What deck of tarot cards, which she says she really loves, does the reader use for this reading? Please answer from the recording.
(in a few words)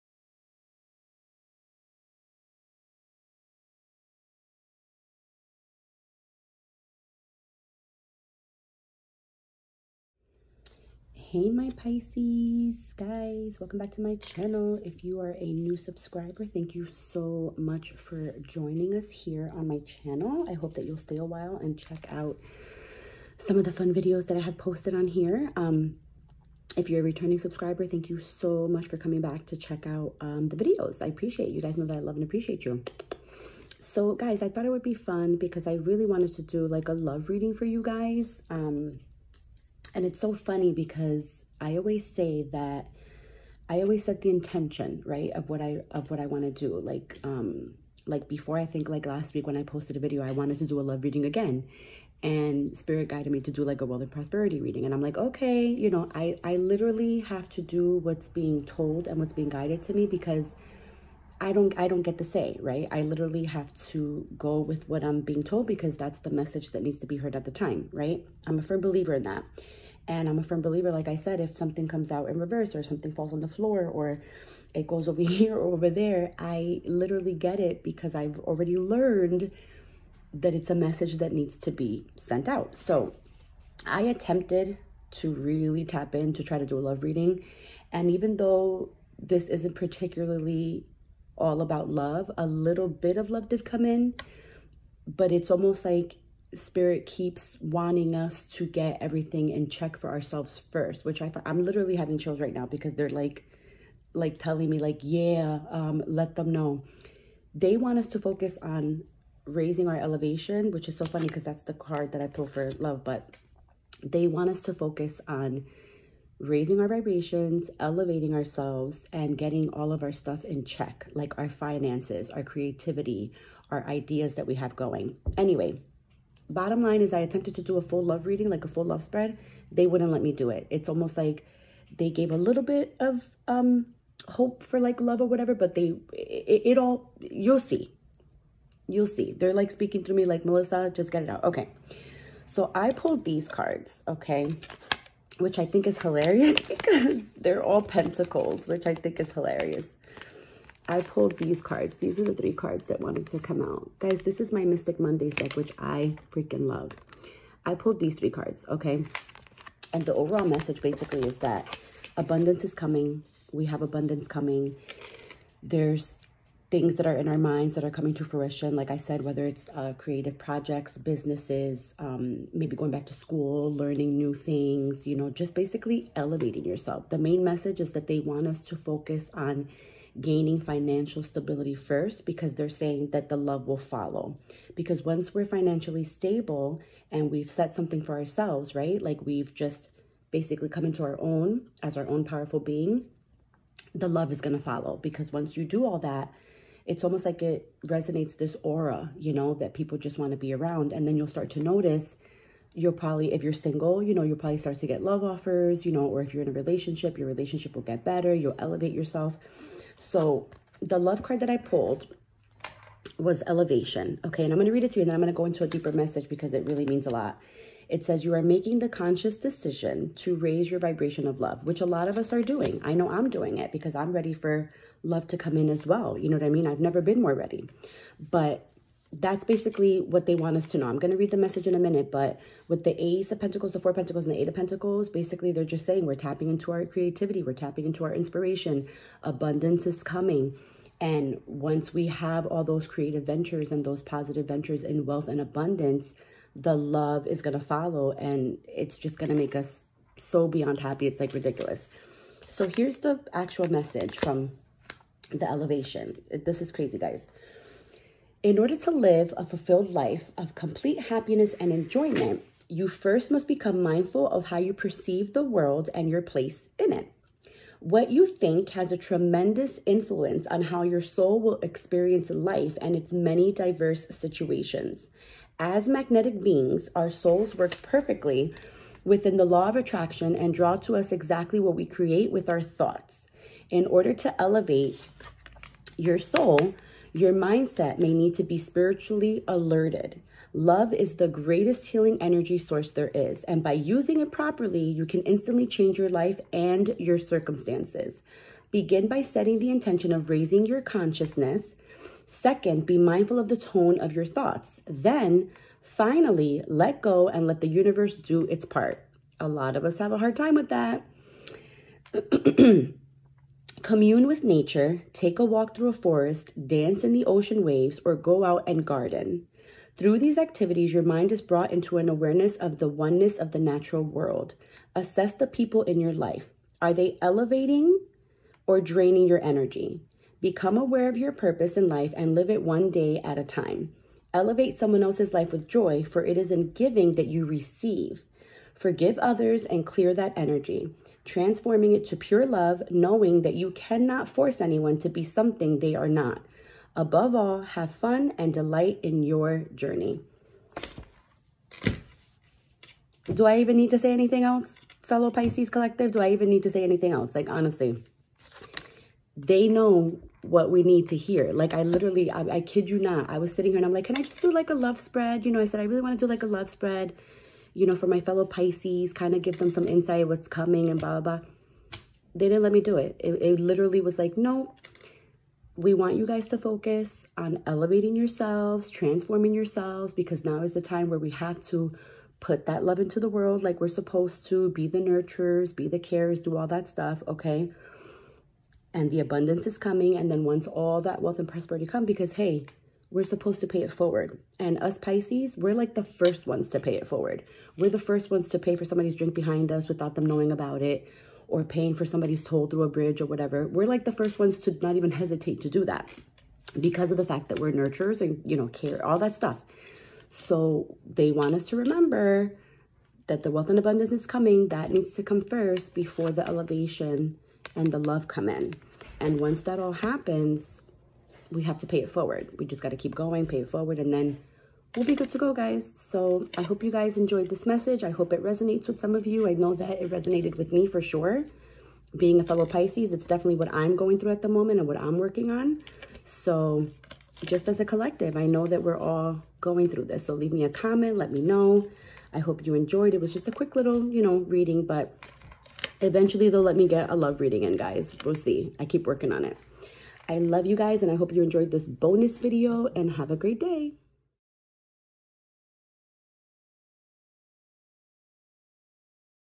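Mystic Mondays.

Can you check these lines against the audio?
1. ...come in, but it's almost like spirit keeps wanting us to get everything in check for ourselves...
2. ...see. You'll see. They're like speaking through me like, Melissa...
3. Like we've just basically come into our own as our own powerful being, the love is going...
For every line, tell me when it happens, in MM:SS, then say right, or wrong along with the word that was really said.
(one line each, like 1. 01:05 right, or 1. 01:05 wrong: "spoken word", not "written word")
1. 01:33 right
2. 02:17 right
3. 03:09 right.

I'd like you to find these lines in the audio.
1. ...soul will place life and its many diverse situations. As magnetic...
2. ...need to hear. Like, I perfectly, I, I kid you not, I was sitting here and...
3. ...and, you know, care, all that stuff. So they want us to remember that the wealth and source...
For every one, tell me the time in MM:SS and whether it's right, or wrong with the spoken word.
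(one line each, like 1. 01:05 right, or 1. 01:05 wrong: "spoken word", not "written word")
1. 04:31 wrong: "experience", not "place"
2. 06:00 wrong: "literally", not "perfectly"
3. 06:48 wrong: "abundance", not "source".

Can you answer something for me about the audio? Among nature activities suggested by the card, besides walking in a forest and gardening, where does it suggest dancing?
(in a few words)
in the ocean waves.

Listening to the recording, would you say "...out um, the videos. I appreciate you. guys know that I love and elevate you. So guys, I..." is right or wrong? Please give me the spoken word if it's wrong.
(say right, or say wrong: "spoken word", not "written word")
wrong: "appreciate", not "elevate".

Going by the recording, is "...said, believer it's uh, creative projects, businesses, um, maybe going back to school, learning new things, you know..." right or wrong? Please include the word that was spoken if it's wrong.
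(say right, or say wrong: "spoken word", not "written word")
wrong: "whether", not "believer".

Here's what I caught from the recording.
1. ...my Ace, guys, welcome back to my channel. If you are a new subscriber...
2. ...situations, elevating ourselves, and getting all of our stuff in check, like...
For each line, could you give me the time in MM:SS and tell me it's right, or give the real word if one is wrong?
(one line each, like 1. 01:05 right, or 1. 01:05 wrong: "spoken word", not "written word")
1. 00:11 wrong: "Pisces", not "Ace"
2. 01:56 wrong: "vibrations", not "situations".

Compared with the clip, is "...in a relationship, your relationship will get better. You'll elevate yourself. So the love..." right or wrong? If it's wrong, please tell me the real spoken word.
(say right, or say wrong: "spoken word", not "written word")
right.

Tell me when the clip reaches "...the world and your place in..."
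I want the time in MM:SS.
04:25.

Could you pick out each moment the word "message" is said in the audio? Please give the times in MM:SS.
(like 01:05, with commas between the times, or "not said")
01:06, 01:20, 02:40, 02:57, 03:35, 03:51, 04:13, 07:07.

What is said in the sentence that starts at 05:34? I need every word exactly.
Elevate someone else's life with joy, for it is in giving that you receive.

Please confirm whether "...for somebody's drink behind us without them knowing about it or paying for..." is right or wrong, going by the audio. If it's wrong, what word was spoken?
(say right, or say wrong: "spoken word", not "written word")
right.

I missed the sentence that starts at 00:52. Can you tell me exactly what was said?
And spirit guided me to do like a wealth and prosperity reading.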